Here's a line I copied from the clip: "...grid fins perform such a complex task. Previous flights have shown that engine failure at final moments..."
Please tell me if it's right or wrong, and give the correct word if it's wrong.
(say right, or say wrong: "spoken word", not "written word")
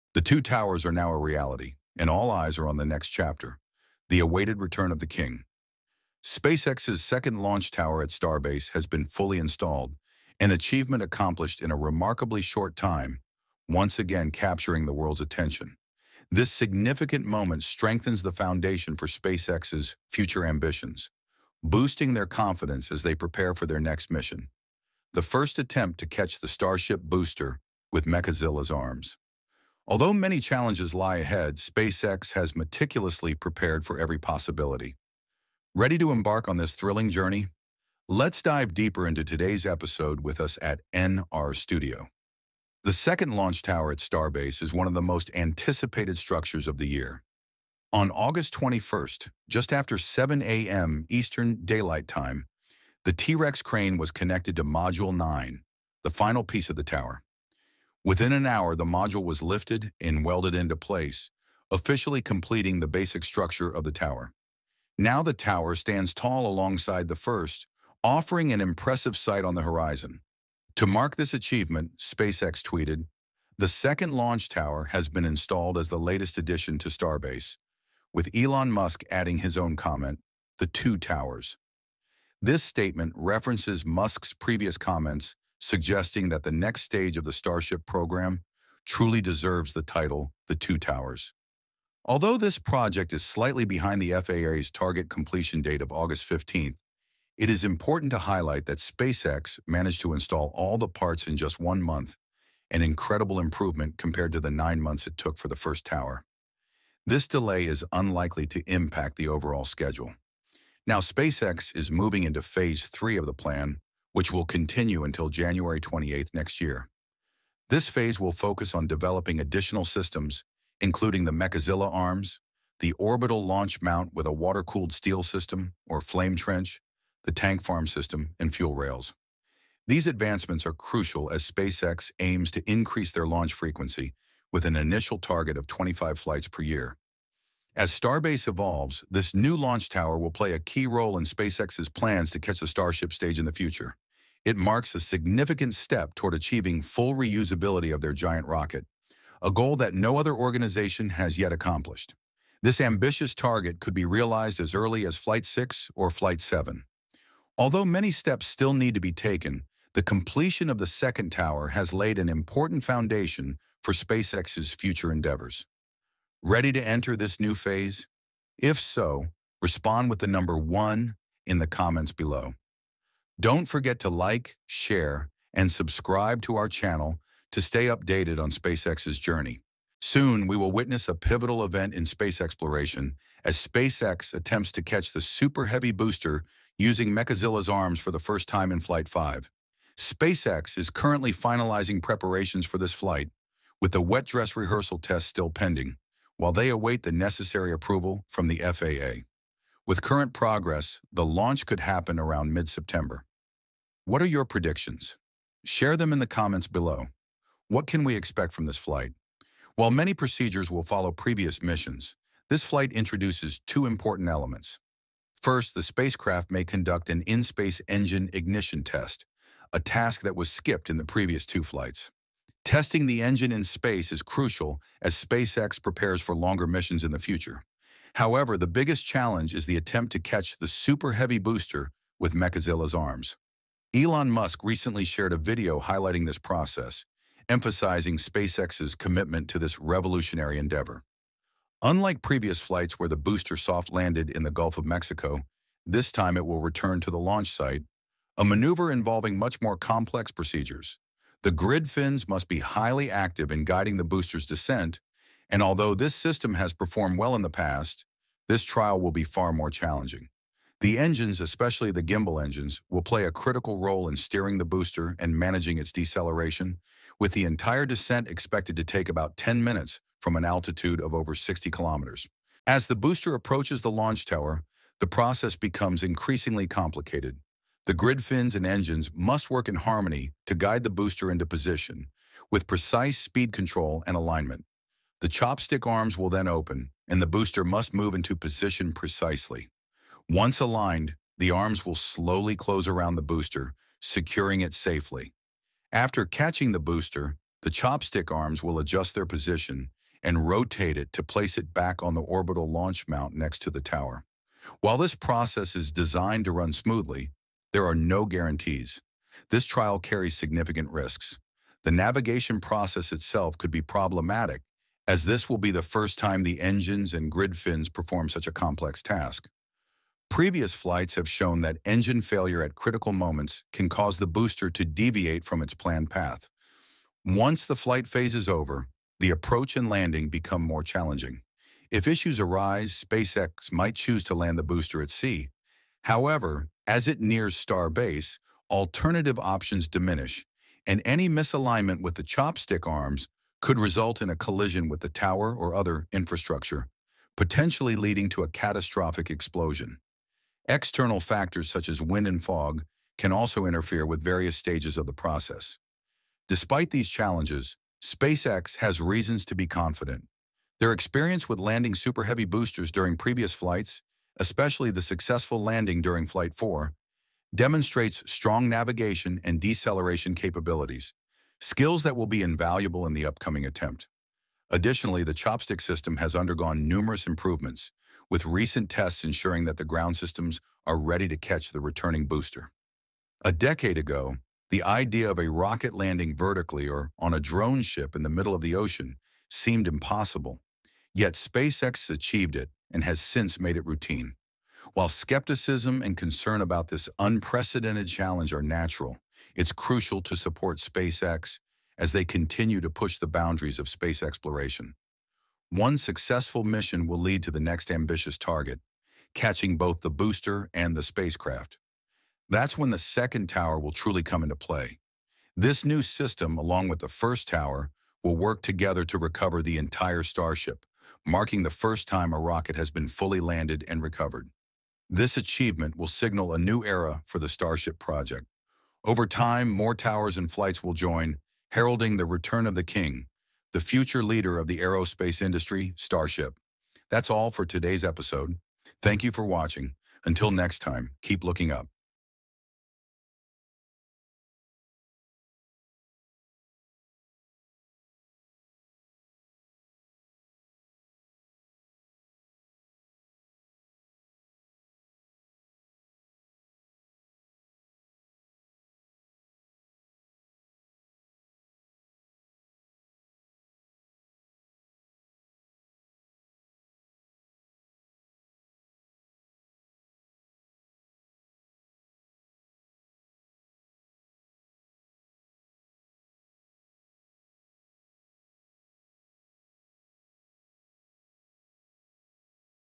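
wrong: "critical", not "final".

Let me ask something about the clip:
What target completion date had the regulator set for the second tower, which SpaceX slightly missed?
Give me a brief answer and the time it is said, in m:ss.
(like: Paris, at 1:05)
August 15th, at 1:35.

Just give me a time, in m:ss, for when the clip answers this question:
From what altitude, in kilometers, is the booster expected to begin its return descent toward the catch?
4:31.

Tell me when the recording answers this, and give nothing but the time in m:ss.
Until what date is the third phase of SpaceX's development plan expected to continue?
1:55.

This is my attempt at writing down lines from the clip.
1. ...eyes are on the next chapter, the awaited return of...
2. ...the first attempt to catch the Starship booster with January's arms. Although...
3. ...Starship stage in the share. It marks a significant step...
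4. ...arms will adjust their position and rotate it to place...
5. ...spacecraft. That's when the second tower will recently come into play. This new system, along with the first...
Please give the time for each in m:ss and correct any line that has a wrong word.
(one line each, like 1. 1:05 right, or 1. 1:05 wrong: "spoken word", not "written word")
1. 0:02 right
2. 0:25 wrong: "Mechazilla", not "January"
3. 2:22 wrong: "future", not "share"
4. 4:58 right
5. 6:51 wrong: "truly", not "recently".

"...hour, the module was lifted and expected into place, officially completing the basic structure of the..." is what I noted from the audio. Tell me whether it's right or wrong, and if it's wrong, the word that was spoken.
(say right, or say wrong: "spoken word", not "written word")
wrong: "welded", not "expected".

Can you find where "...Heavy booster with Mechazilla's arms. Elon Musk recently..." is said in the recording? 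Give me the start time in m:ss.
3:51.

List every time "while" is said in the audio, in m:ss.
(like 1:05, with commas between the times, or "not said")
3:16, 3:29, 5:04, 6:34.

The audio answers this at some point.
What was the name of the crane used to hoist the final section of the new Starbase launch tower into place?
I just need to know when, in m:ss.
0:53.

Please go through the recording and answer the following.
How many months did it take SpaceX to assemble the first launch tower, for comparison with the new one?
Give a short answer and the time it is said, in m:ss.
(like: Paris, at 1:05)
9, at 1:44.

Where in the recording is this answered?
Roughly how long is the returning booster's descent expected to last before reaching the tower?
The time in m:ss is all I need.
4:29.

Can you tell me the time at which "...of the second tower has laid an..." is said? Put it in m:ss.
2:40.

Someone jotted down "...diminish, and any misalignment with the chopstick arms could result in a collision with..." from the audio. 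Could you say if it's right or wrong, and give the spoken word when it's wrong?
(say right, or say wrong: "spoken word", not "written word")
right.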